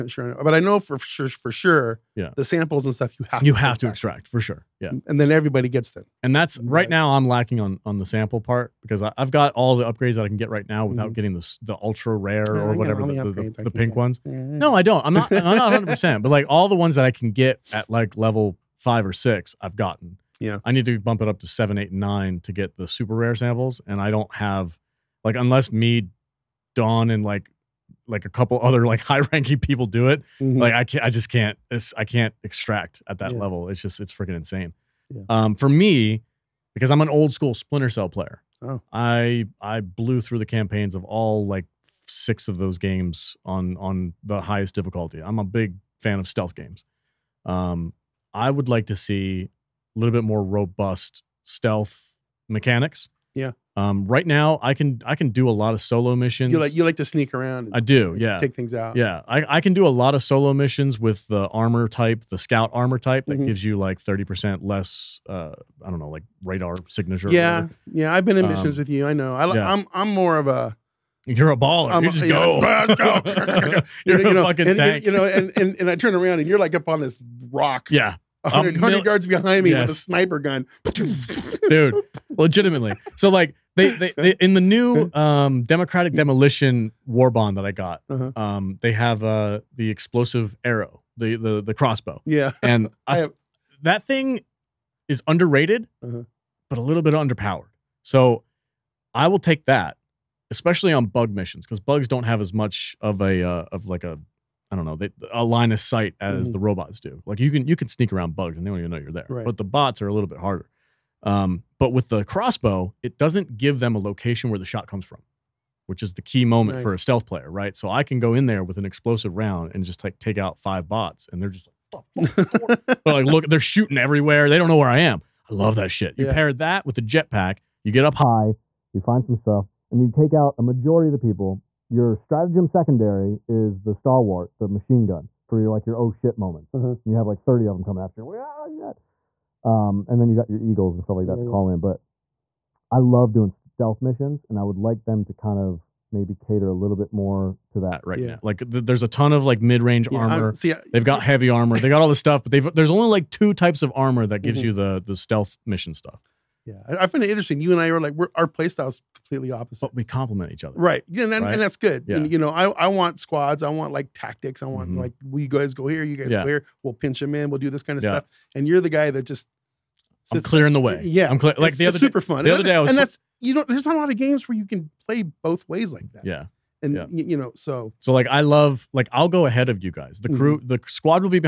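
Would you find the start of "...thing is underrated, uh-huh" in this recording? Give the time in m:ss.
1:34.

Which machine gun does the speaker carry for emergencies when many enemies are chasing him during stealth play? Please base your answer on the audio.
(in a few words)
Stalwart.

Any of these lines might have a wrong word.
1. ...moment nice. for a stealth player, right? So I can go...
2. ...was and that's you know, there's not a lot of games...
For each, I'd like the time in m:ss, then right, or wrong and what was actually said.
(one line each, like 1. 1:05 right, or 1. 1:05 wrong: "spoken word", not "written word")
1. 1:56 right
2. 2:52 right.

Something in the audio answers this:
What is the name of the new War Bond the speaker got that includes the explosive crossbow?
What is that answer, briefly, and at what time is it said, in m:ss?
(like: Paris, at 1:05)
Democratic Demolition, at 1:25.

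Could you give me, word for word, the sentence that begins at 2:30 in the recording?
see, I, they've got heavy armor.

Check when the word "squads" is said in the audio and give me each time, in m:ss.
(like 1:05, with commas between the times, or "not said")
2:43, 3:00.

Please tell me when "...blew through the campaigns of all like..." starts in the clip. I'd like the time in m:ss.
0:39.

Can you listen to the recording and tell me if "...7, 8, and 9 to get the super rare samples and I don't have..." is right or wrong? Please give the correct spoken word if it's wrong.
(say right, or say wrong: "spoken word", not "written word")
right.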